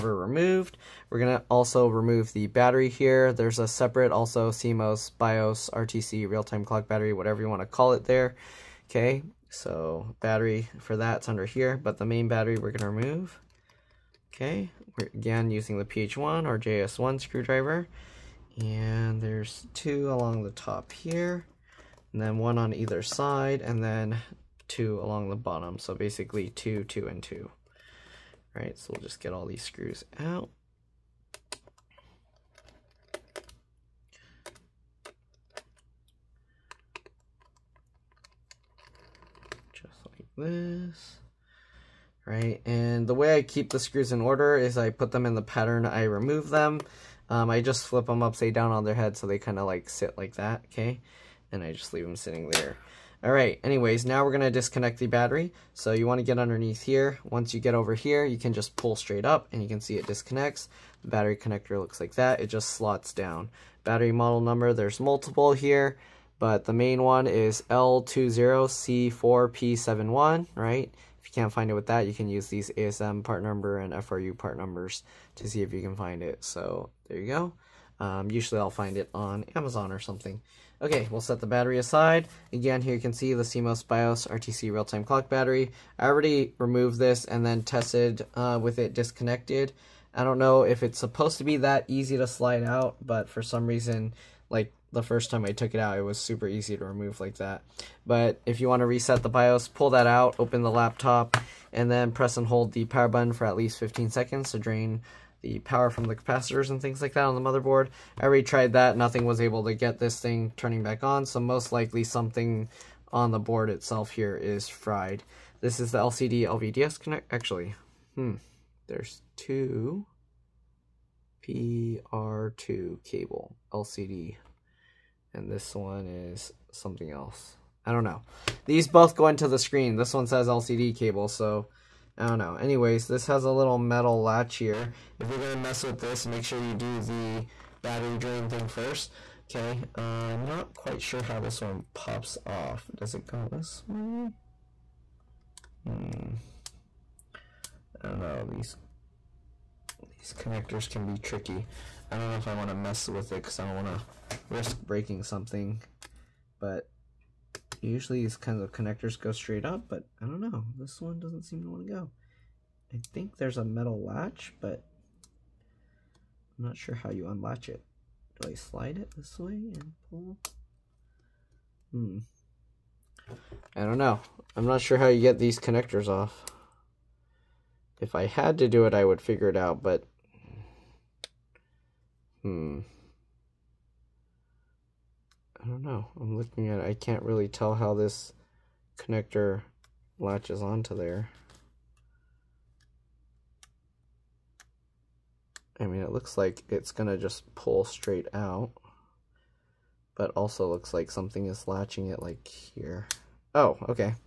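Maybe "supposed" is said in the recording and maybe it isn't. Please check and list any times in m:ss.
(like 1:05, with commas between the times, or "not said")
1:30.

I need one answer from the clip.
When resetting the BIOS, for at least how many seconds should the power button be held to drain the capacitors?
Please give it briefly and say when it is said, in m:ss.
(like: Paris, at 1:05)
15 seconds, at 1:43.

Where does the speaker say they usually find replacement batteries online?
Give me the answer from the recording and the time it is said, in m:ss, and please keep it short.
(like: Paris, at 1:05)
Amazon, at 1:19.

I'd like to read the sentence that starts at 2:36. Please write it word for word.
But Usually these kinds of connectors go straight up, but I don't know.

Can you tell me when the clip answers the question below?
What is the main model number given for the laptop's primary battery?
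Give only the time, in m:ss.
1:07.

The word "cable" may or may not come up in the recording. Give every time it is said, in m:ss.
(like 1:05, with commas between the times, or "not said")
2:03, 2:10.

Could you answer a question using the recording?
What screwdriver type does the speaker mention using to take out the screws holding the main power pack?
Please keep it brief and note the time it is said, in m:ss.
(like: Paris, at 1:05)
PH1 or JIS1, at 0:15.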